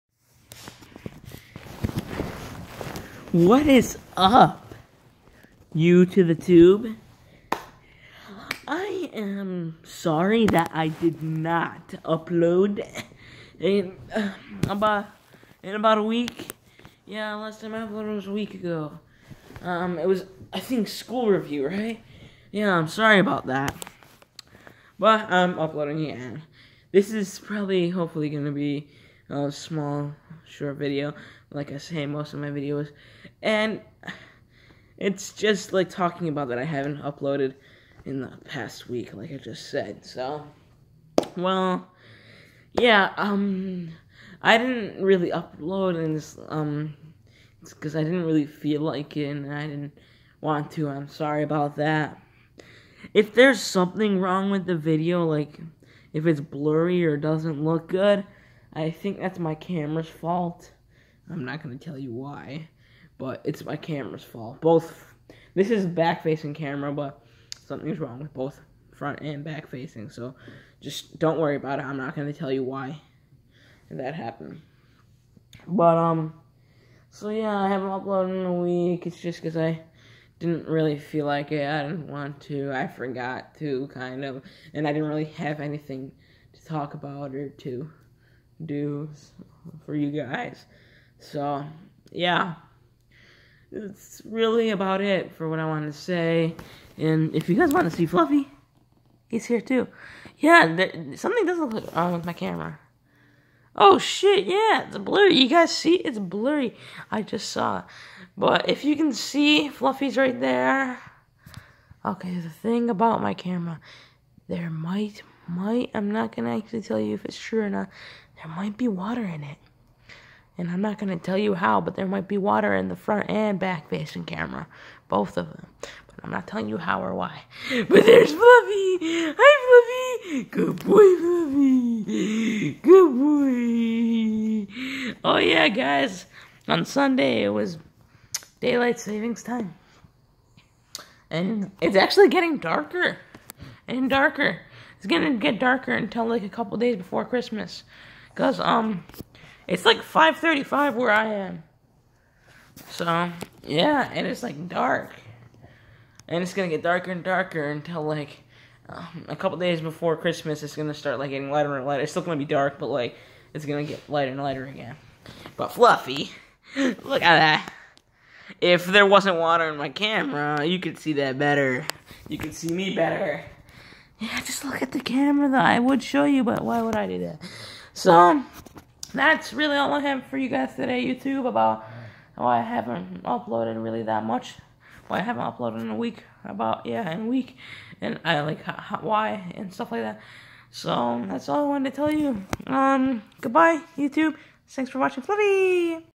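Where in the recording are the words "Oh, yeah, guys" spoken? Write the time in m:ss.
2:15.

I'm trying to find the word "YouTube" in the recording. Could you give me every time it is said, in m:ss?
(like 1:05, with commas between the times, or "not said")
3:01, 3:13.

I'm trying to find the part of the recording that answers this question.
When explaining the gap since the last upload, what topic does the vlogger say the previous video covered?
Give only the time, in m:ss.
0:20.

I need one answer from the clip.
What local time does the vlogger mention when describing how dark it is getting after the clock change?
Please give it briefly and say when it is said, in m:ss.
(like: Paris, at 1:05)
5:35, at 2:29.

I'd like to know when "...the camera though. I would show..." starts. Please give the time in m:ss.
2:54.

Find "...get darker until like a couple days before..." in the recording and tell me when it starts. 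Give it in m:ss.
2:25.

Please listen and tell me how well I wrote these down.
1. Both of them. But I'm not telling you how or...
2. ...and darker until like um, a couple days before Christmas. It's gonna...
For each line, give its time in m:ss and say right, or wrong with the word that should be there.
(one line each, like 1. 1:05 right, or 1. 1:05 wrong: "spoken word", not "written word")
1. 2:05 right
2. 2:37 right.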